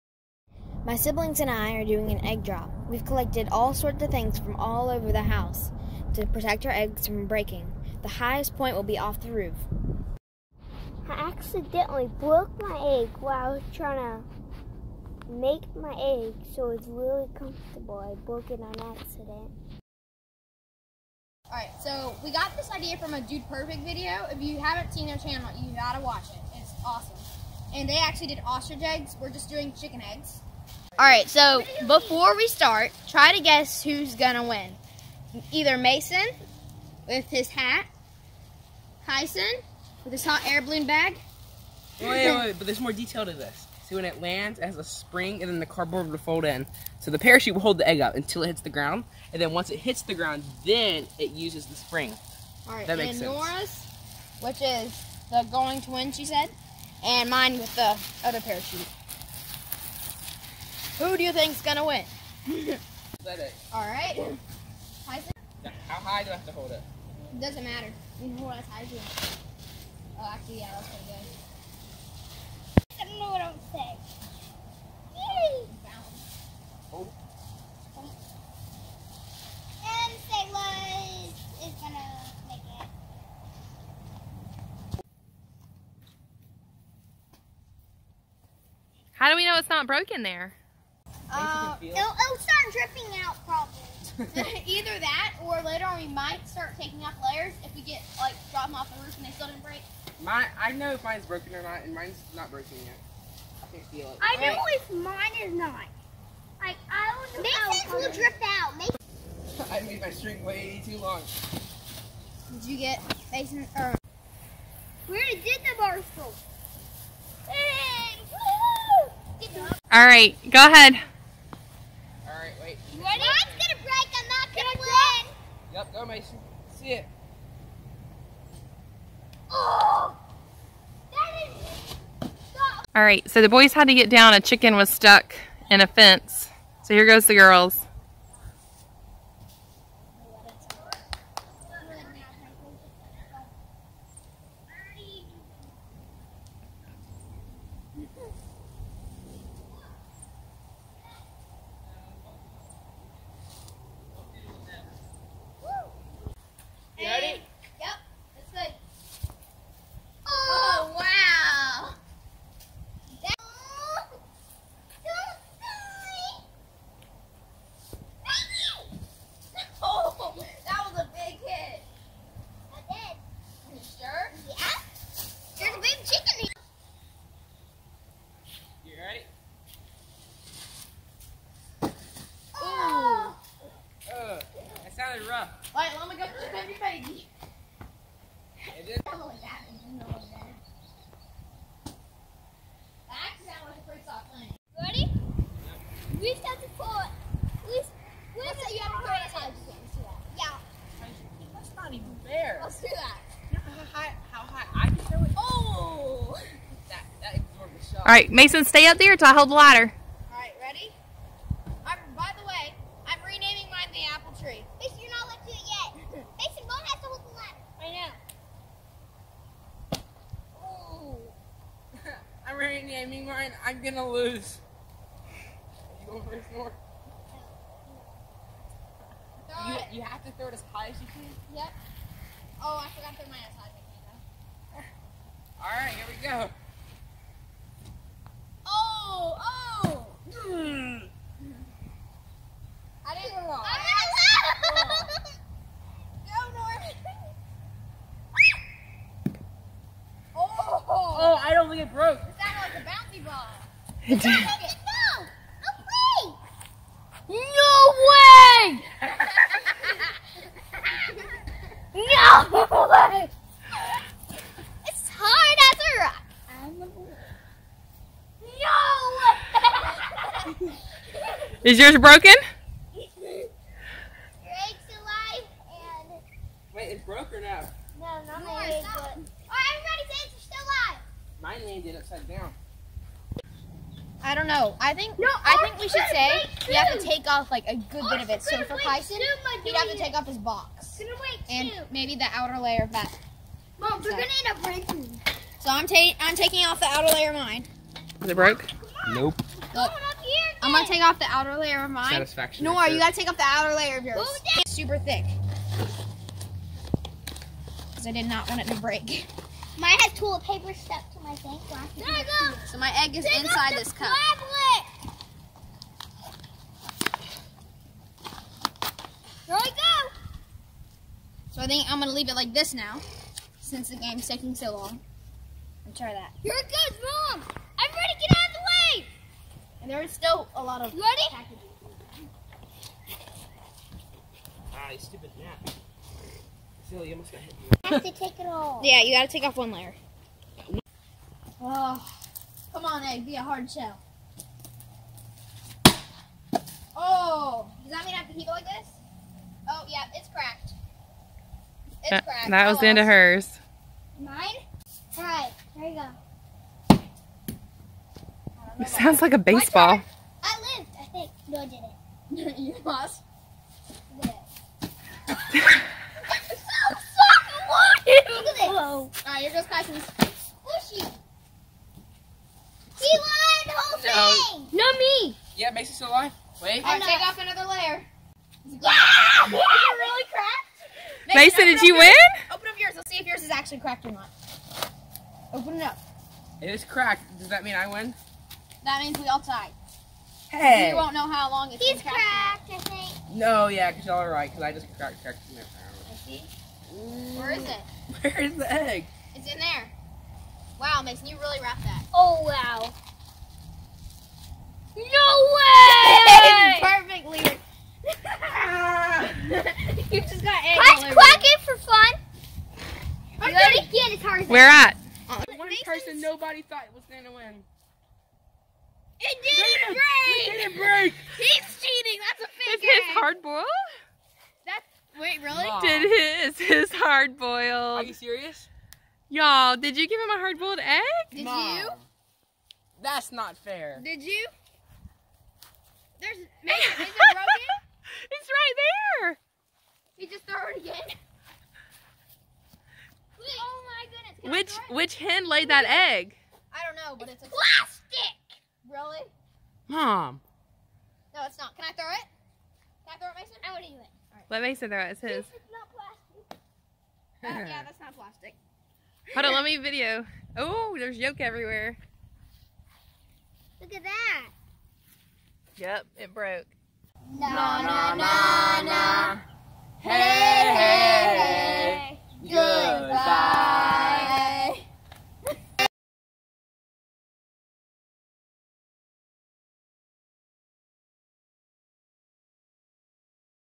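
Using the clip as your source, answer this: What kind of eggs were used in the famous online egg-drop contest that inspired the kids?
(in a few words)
ostrich eggs.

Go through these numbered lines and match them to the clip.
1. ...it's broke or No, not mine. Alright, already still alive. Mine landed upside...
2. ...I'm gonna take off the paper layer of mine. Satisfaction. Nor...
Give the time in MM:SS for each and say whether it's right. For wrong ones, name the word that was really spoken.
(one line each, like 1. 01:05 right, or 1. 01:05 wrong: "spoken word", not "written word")
1. 04:36 wrong: "everybody", not "already"
2. 05:00 wrong: "outer", not "paper".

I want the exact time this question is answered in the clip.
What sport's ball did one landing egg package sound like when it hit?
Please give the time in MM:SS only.
05:59.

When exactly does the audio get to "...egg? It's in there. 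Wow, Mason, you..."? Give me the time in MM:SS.
06:38.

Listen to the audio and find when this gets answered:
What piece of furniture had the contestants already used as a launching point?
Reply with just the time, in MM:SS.
01:55.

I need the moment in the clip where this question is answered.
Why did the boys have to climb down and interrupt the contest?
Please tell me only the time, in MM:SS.
02:14.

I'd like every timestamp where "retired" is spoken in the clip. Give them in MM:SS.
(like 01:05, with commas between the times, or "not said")
not said.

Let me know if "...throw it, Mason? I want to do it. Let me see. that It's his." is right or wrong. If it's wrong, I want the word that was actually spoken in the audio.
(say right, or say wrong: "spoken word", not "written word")
right.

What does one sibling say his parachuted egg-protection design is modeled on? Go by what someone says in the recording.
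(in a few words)
hot air balloon bag.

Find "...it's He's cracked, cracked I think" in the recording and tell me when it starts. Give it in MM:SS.
06:31.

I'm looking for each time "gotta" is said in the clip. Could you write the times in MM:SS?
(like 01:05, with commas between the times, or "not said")
00:25, 05:02, 05:39.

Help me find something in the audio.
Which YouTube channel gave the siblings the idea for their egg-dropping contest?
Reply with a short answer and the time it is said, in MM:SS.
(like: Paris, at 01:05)
Dude Perfect, at 00:23.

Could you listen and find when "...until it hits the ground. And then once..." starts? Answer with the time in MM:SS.
00:48.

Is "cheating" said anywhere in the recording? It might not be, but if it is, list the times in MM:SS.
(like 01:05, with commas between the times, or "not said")
07:01.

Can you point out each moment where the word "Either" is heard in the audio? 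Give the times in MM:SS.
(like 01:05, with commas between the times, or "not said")
00:35, 01:34.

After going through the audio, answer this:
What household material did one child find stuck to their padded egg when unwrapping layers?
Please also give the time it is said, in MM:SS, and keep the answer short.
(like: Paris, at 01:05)
toilet paper, at 05:10.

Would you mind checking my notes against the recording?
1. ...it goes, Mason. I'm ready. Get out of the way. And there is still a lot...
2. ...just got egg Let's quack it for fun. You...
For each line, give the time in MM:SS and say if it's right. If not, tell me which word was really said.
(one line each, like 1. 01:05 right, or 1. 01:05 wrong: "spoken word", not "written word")
1. 05:26 wrong: "Mom", not "Mason"
2. 06:50 right.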